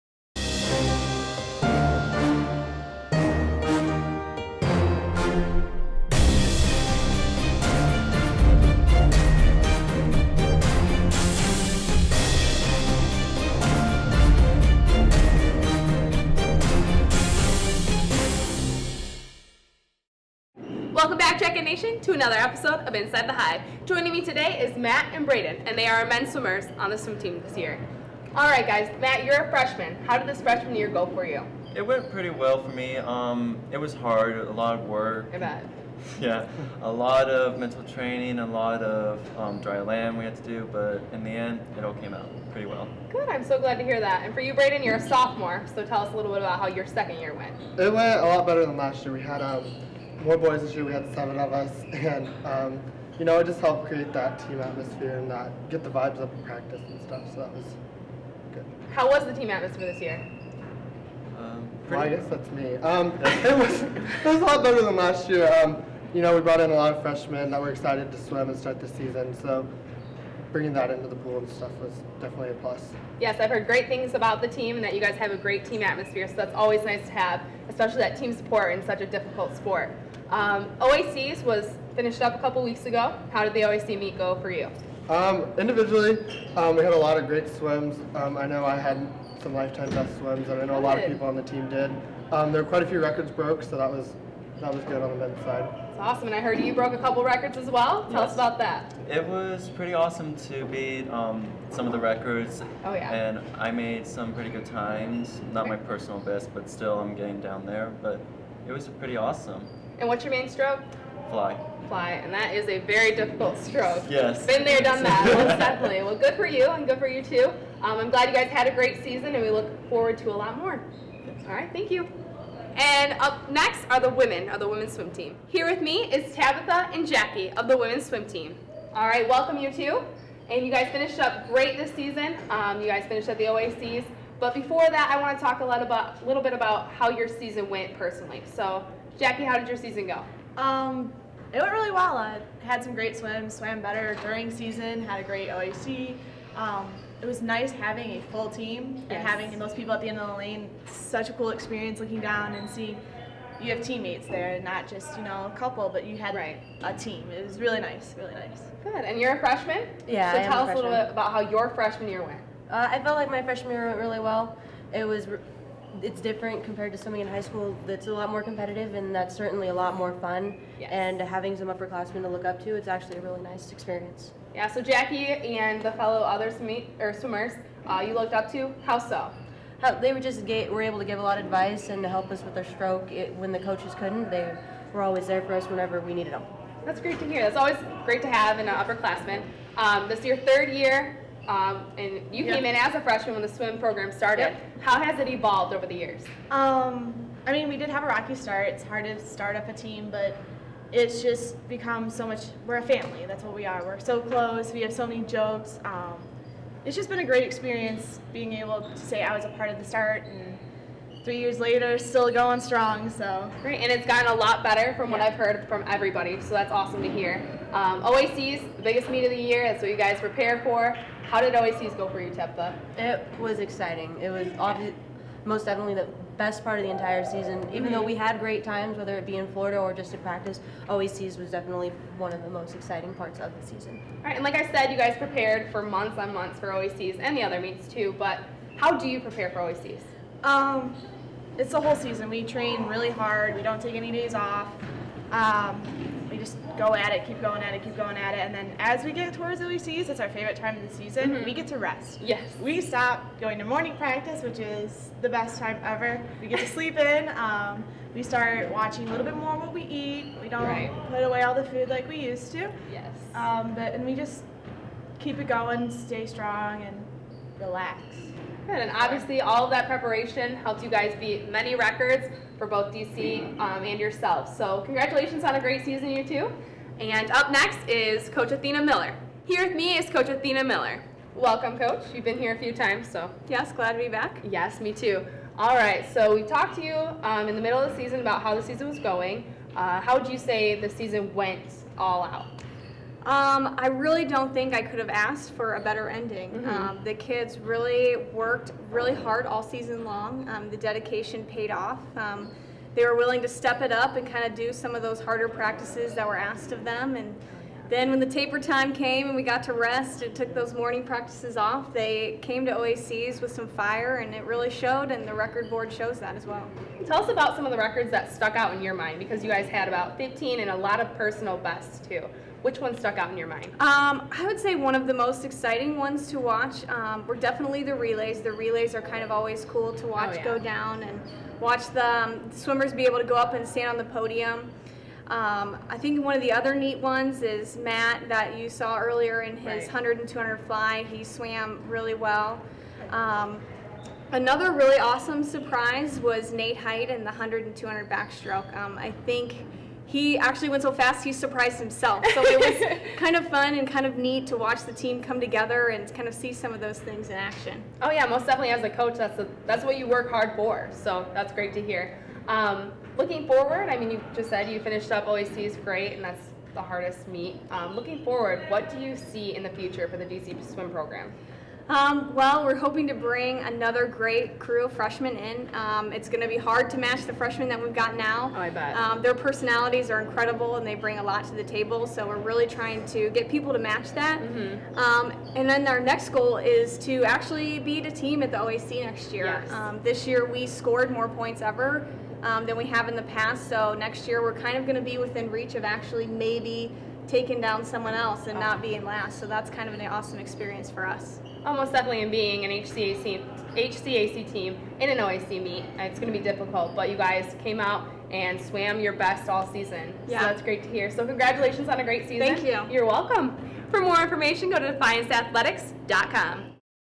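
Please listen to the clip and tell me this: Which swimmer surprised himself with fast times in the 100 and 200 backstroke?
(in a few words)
Nate Height.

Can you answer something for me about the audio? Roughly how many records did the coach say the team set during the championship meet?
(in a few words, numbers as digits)
15.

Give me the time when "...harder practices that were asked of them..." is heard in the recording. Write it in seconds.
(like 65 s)
305 s.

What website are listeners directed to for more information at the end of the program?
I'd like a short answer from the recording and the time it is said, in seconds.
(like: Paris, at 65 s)
defianceathletics.com, at 414 s.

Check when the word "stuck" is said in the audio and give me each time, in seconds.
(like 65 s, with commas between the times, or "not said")
318 s, 322 s.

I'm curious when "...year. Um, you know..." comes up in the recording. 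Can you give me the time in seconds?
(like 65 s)
65 s.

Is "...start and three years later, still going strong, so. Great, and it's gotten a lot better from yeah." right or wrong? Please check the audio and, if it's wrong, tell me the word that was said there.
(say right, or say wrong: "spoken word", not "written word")
right.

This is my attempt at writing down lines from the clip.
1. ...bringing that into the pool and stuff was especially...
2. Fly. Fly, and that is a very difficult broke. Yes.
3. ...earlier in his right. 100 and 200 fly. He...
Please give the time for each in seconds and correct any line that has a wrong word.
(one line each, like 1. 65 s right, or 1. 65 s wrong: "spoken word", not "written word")
1. 70 s wrong: "definitely", not "especially"
2. 111 s wrong: "stroke", not "broke"
3. 338 s right.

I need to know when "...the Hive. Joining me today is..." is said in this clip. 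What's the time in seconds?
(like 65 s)
23 s.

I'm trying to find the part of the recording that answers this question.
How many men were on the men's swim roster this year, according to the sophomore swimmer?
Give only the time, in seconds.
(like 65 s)
51 s.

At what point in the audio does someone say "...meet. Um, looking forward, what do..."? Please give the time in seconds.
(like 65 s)
367 s.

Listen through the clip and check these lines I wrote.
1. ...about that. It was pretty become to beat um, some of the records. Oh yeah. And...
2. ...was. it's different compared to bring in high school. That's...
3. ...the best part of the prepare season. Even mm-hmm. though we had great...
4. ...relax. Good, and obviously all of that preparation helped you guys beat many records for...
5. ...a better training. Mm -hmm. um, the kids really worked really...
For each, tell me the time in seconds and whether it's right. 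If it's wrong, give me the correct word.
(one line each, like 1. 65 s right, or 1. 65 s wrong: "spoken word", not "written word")
1. 98 s wrong: "awesome", not "become"
2. 165 s wrong: "swimming", not "bring"
3. 225 s wrong: "entire", not "prepare"
4. 267 s right
5. 295 s wrong: "ending", not "training".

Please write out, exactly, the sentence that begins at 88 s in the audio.
Um, I know I had some lifetime best swims, and I know Good.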